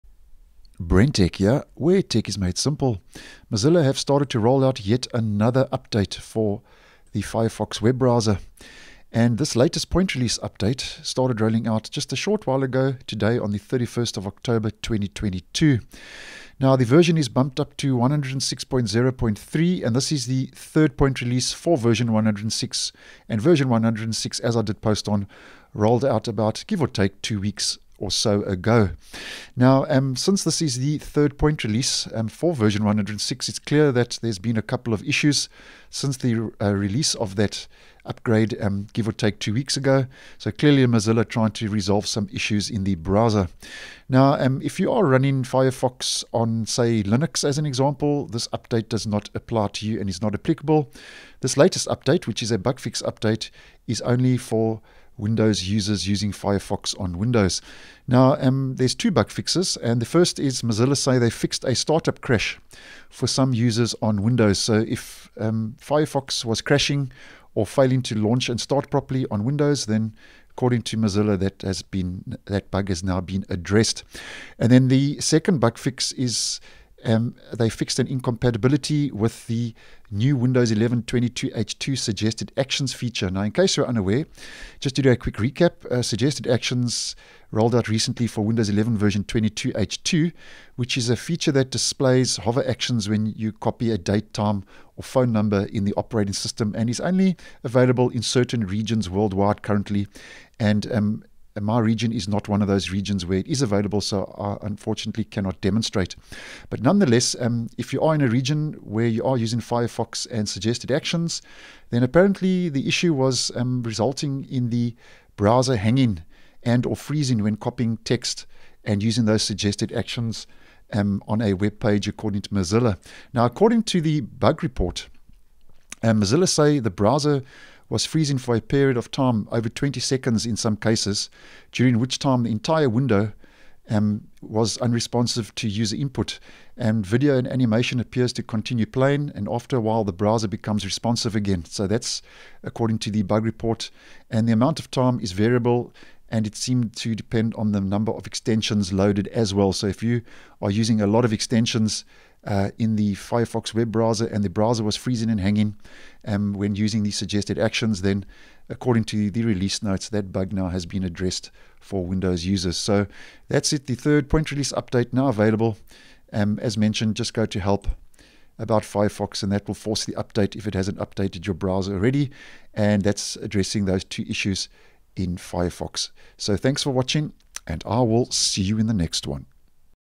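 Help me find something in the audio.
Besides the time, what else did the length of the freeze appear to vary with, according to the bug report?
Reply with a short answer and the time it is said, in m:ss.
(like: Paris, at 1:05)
Number of extensions loaded, at 2:27.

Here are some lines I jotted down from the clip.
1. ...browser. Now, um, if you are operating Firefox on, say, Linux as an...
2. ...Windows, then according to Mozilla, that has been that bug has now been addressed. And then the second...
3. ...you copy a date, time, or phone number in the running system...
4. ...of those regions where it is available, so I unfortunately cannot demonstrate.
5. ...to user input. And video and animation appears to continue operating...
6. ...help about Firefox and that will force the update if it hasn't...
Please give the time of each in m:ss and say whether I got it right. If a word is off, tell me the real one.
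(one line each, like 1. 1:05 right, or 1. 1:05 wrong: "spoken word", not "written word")
1. 0:42 wrong: "running", not "operating"
2. 1:09 right
3. 1:33 wrong: "operating", not "running"
4. 1:42 right
5. 2:15 wrong: "playing", not "operating"
6. 2:47 right.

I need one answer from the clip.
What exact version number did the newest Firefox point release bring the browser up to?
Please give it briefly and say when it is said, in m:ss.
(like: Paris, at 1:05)
106.0.3, at 0:17.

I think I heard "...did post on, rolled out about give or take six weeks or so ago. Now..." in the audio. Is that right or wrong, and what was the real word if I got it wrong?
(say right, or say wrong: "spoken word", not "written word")
wrong: "two", not "six".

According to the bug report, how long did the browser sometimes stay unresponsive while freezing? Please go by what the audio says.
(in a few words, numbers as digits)
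Over 20 seconds.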